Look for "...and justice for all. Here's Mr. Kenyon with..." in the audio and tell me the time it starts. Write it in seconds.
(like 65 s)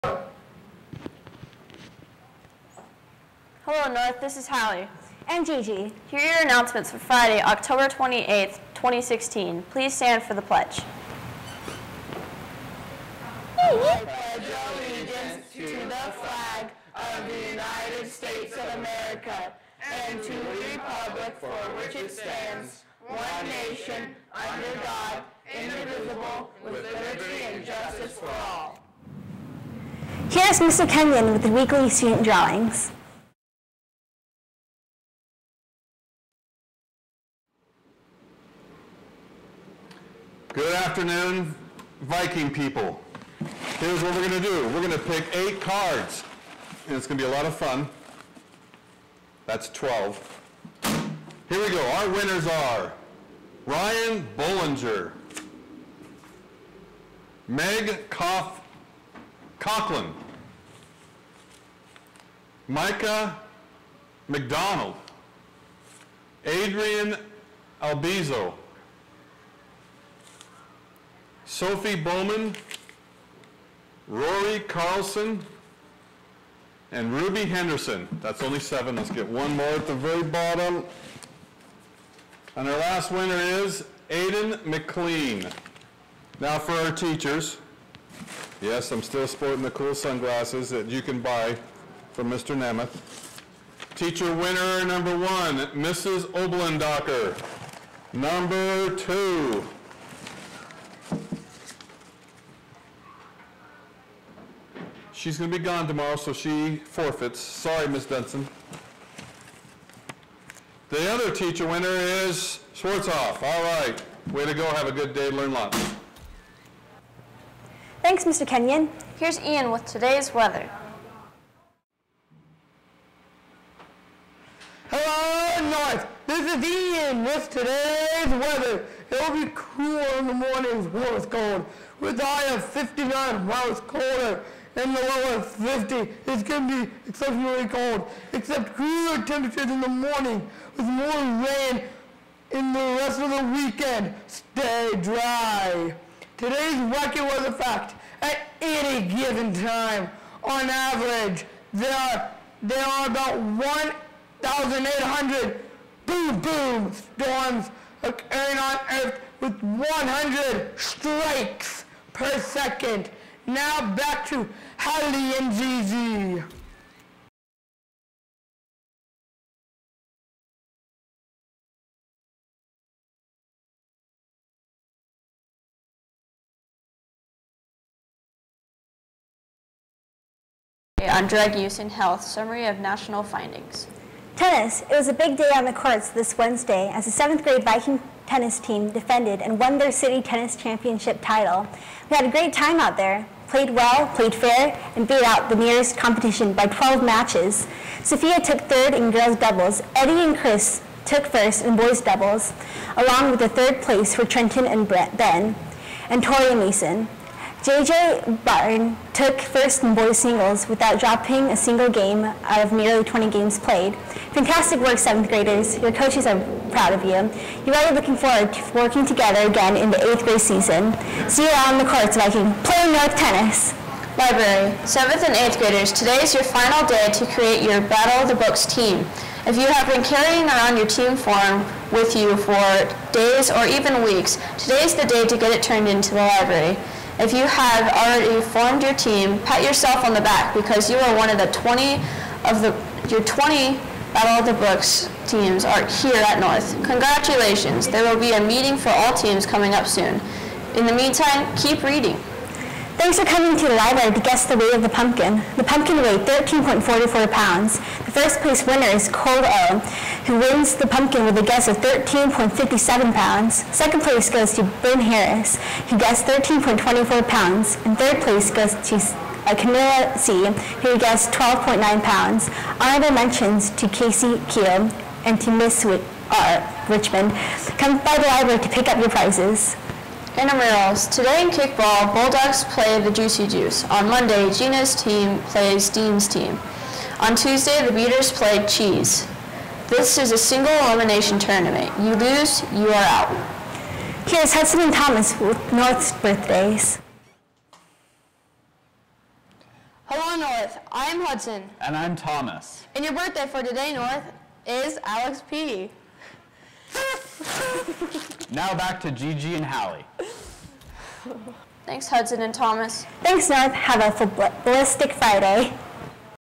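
27 s.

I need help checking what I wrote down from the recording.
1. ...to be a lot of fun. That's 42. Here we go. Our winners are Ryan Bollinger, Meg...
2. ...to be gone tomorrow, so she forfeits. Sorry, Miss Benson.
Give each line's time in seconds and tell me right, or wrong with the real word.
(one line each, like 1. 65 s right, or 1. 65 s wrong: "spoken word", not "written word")
1. 47 s wrong: "12", not "42"
2. 105 s right.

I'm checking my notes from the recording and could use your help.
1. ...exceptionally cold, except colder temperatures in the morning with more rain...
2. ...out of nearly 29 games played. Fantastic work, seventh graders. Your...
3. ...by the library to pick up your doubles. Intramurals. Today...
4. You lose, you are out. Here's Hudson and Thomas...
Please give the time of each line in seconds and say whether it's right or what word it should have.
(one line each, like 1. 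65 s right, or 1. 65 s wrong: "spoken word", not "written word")
1. 137 s wrong: "cooler", not "colder"
2. 212 s wrong: "20", not "29"
3. 277 s wrong: "prizes", not "doubles"
4. 291 s right.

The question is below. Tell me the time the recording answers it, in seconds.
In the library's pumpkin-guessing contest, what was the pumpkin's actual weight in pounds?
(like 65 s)
256 s.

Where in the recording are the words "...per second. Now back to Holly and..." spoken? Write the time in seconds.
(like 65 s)
162 s.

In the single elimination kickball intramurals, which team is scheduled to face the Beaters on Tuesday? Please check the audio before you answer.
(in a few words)
Cheese.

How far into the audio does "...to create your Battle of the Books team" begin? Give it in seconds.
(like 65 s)
227 s.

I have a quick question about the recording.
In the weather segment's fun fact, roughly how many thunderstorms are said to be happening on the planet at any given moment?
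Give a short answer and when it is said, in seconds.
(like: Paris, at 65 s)
1,800, at 153 s.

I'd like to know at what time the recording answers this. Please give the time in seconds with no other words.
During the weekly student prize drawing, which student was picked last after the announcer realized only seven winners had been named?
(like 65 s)
84 s.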